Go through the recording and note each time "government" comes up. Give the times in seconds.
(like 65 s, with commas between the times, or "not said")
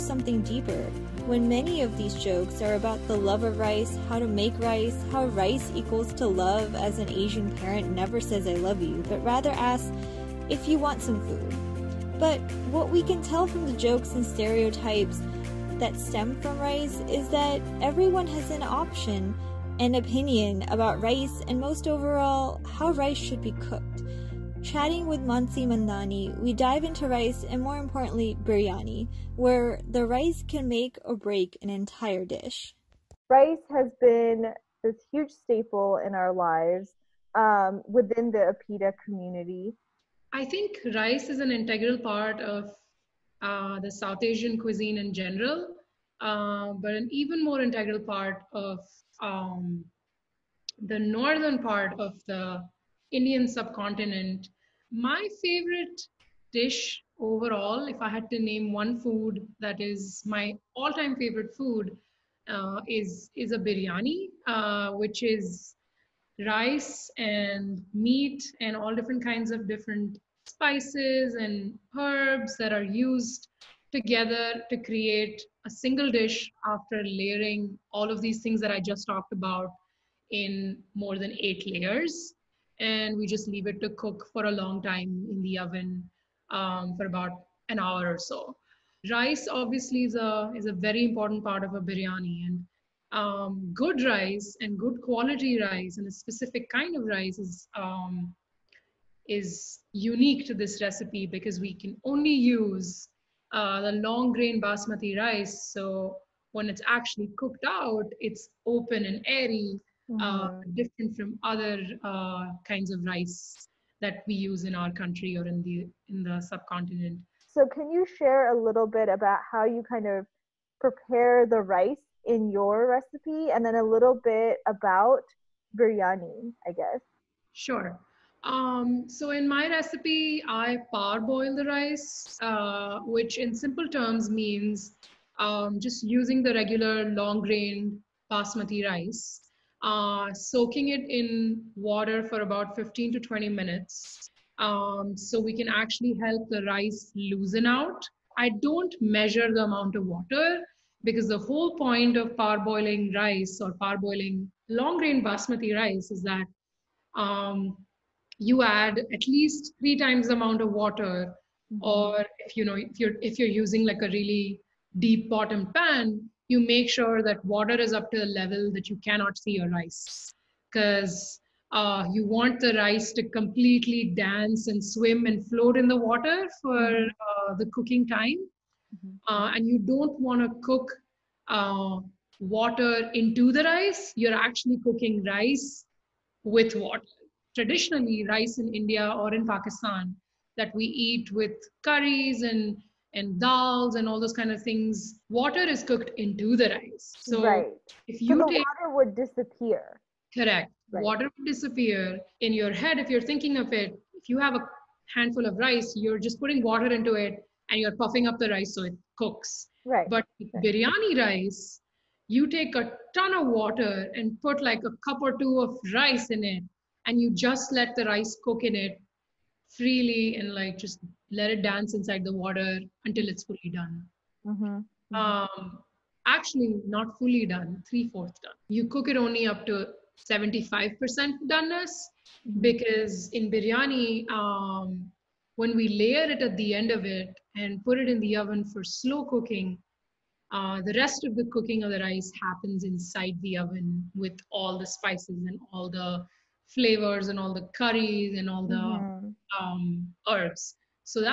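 not said.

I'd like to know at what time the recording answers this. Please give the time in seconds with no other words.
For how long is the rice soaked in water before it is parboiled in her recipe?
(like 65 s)
142 s.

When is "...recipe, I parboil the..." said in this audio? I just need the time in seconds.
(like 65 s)
129 s.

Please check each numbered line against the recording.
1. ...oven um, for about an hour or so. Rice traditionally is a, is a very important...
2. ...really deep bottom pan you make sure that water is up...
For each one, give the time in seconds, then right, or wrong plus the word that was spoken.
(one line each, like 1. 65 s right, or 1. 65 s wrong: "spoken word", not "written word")
1. 85 s wrong: "obviously", not "traditionally"
2. 164 s right.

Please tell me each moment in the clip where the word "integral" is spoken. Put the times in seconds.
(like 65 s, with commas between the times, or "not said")
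41 s, 47 s.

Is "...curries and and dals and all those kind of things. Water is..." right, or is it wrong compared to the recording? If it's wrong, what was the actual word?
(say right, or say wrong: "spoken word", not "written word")
right.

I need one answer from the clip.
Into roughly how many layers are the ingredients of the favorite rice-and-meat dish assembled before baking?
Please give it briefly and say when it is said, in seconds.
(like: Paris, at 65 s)
More than 8, at 80 s.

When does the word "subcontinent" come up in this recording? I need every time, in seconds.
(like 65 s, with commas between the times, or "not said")
53 s, 116 s.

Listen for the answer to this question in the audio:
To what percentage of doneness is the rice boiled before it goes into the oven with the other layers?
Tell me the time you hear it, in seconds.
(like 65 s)
230 s.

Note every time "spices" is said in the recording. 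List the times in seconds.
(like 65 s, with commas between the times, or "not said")
70 s, 244 s.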